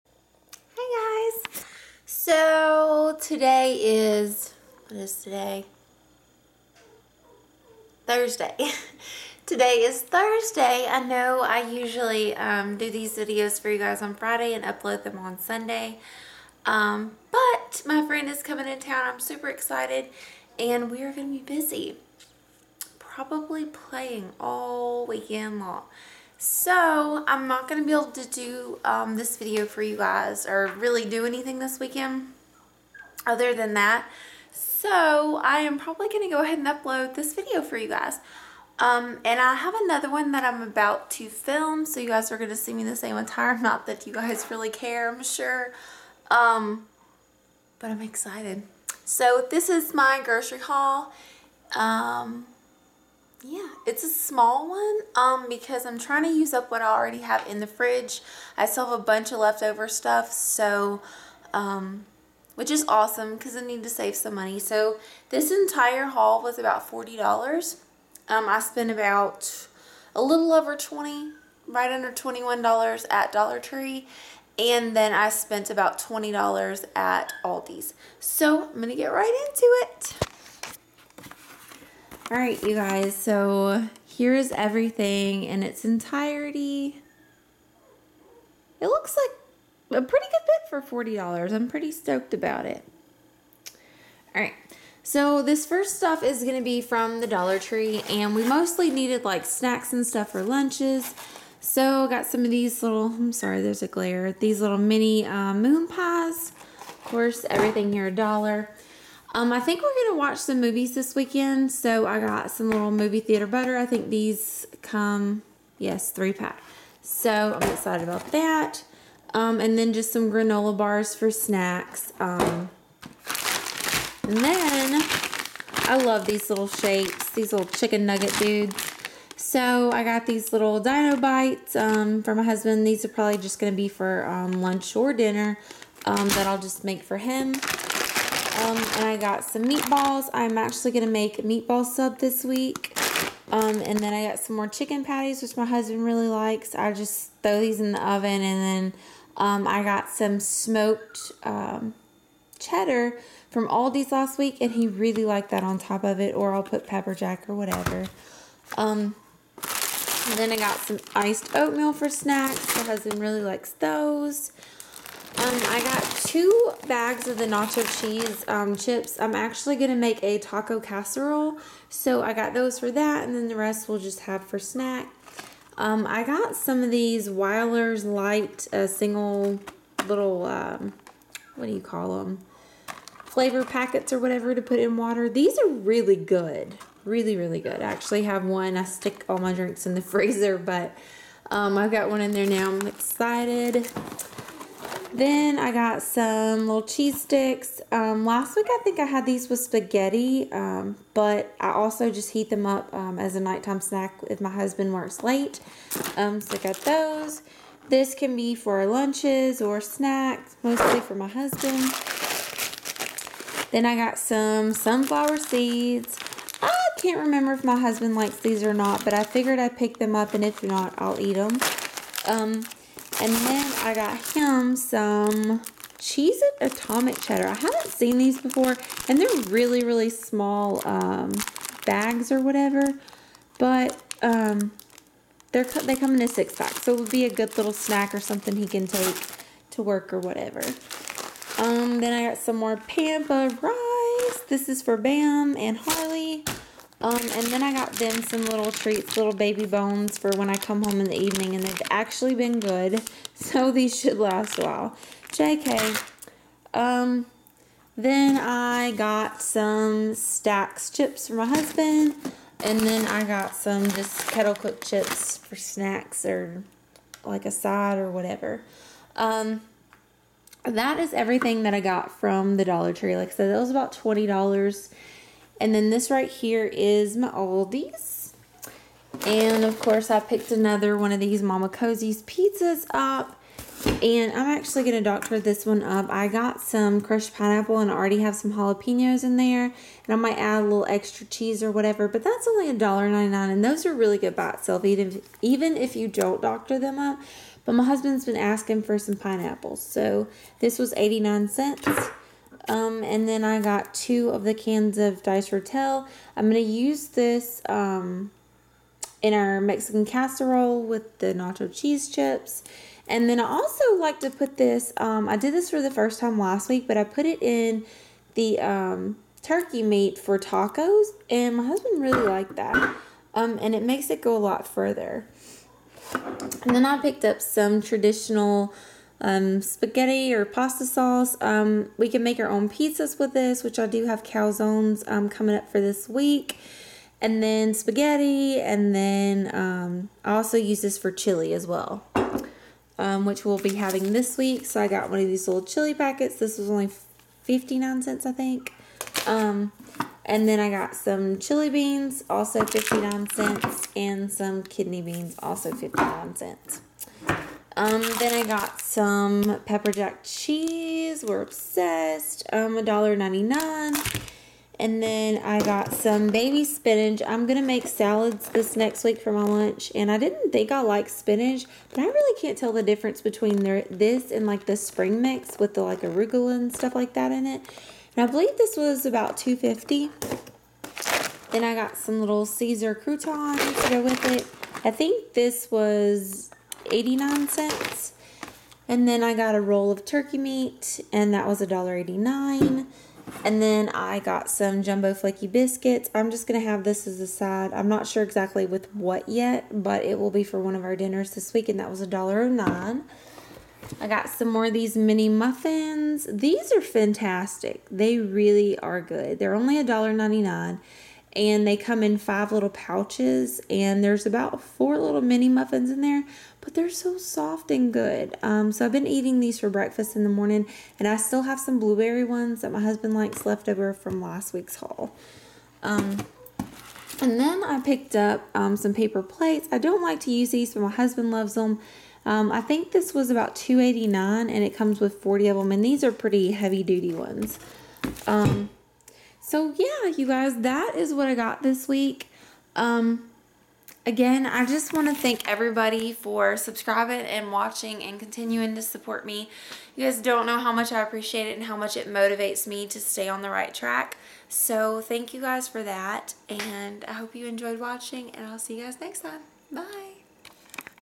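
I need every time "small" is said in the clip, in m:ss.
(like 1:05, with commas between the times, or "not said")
0:54, 3:50.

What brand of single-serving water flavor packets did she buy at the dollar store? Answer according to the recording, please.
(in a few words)
Wyler's Light.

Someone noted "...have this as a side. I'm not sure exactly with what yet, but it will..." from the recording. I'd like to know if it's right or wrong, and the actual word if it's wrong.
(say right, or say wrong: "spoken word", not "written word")
right.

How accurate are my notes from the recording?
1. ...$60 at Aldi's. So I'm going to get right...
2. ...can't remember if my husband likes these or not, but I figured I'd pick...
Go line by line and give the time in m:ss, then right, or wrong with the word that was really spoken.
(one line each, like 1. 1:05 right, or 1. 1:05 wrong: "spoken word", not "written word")
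1. 1:15 wrong: "20", not "60"
2. 3:37 right.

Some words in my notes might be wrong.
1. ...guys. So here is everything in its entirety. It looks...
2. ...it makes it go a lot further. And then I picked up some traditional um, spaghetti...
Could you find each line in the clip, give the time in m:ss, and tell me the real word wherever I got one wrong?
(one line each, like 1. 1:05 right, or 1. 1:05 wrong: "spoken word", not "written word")
1. 1:22 right
2. 5:23 right.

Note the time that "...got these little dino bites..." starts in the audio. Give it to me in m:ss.
2:10.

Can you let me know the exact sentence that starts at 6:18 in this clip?
And I believe this was about 250 Then I got some little Caesar croutons to go with it.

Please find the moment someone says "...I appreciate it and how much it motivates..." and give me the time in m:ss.
7:30.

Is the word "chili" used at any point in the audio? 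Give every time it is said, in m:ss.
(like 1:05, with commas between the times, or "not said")
5:41, 5:45, 5:51.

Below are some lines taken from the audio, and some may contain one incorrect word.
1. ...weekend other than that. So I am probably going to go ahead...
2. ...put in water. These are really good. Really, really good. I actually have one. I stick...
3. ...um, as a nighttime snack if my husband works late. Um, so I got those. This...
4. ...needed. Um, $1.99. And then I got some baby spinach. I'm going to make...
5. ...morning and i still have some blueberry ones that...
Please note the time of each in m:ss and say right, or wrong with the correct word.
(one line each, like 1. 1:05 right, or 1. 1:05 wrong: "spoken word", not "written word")
1. 0:31 right
2. 3:04 right
3. 3:22 right
4. 6:01 wrong: "obsessed", not "needed"
5. 7:00 right.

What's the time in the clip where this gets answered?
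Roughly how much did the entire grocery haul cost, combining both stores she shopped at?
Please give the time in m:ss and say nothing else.
1:06.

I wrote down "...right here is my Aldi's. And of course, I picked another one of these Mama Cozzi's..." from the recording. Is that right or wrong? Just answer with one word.
right.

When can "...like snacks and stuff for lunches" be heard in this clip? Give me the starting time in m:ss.
1:39.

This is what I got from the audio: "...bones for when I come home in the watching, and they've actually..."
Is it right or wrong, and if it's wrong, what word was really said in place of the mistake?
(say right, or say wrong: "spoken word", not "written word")
wrong: "evening", not "watching".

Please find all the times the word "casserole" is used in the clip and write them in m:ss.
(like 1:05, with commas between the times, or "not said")
2:50, 5:10.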